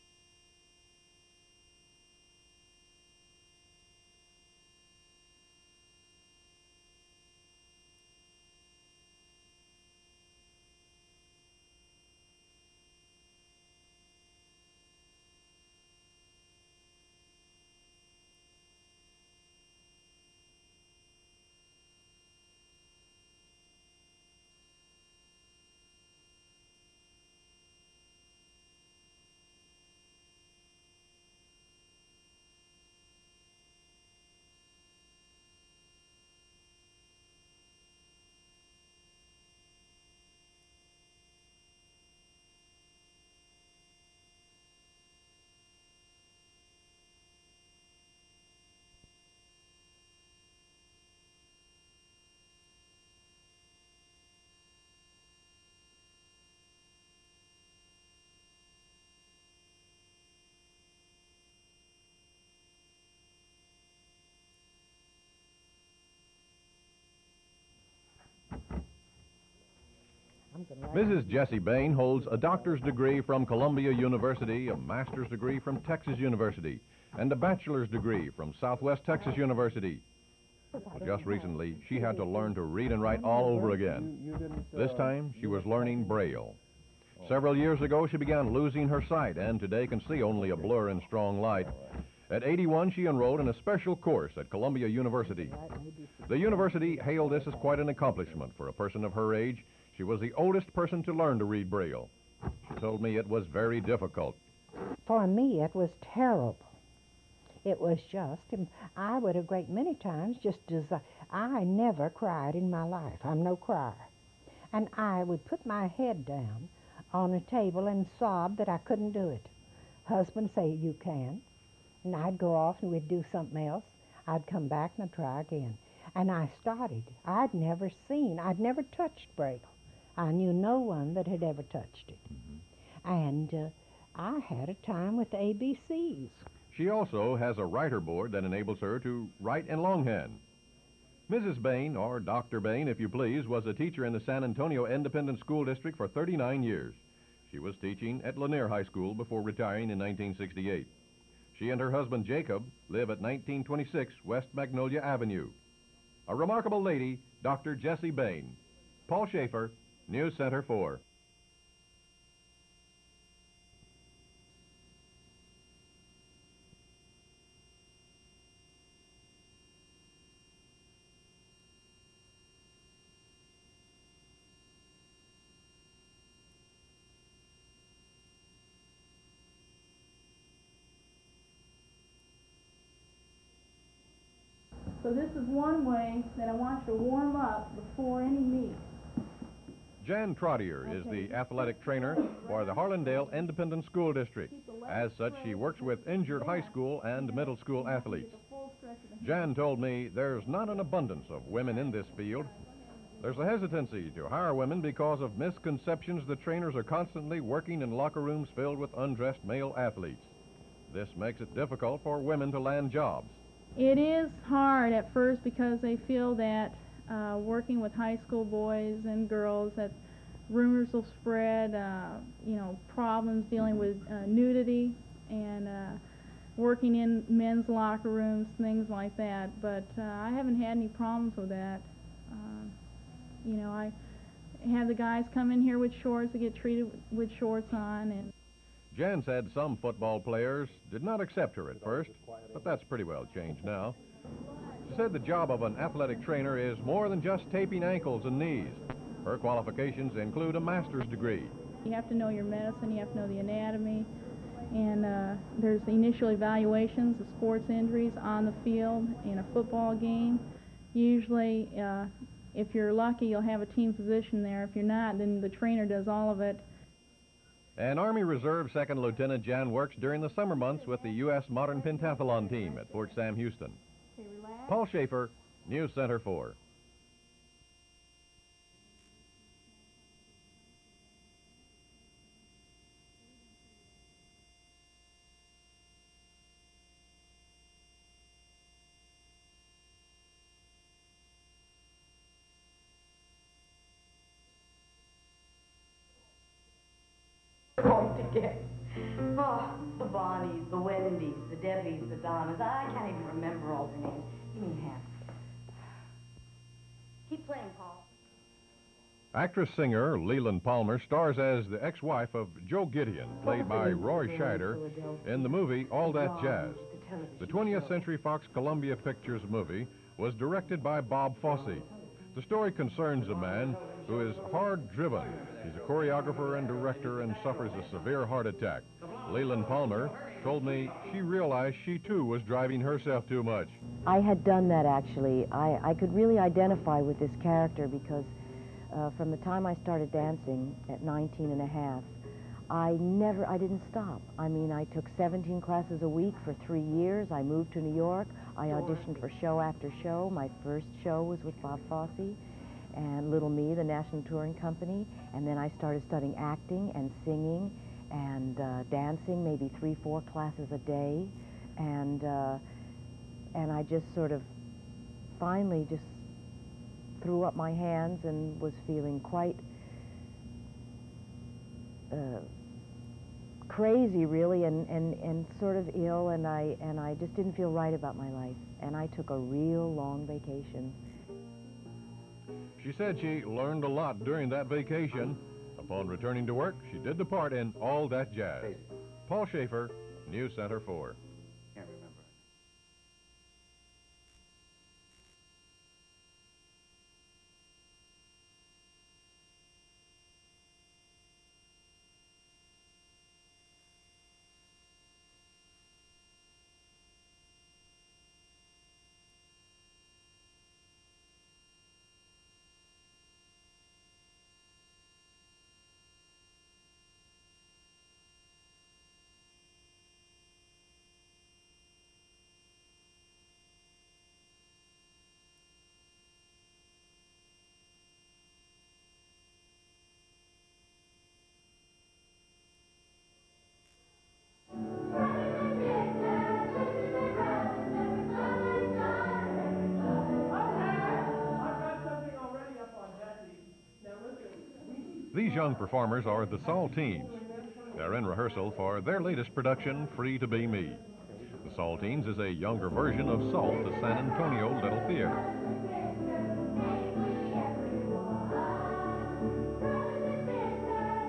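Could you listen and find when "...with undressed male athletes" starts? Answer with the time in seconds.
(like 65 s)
208 s.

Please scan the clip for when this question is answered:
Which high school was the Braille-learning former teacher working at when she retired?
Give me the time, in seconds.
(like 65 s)
148 s.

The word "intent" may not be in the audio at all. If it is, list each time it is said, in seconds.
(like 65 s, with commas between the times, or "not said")
not said.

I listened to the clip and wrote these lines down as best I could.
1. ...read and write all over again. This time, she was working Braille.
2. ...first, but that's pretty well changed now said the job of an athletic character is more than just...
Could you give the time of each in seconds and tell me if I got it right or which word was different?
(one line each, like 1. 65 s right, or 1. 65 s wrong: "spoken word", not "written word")
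1. 82 s wrong: "learning", not "working"
2. 241 s wrong: "trainer", not "character".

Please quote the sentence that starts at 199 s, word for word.
Jan told me there's not an abundance of women in this field.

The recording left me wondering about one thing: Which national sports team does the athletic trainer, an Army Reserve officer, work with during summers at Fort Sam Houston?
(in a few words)
U.S. Modern Pentathlon team.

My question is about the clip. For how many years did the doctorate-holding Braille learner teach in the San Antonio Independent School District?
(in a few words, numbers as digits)
39.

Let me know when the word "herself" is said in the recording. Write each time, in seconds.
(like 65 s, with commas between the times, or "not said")
332 s.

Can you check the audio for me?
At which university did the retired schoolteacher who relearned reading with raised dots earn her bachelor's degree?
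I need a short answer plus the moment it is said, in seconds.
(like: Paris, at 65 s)
Southwest Texas University, at 78 s.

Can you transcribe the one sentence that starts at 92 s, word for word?
At 81, she enrolled in a special course at Columbia University.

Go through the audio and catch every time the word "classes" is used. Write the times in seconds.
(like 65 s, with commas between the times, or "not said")
345 s, 360 s.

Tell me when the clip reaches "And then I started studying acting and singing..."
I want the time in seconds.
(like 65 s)
355 s.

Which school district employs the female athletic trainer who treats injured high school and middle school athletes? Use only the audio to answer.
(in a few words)
Harlandale Independent School District.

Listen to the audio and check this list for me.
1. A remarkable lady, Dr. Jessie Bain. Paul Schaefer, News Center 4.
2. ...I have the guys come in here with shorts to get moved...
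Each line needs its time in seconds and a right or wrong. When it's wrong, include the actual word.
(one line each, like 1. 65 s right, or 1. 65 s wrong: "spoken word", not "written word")
1. 156 s right
2. 233 s wrong: "treated", not "moved".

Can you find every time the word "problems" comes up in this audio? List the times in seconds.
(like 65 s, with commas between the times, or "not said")
222 s, 230 s.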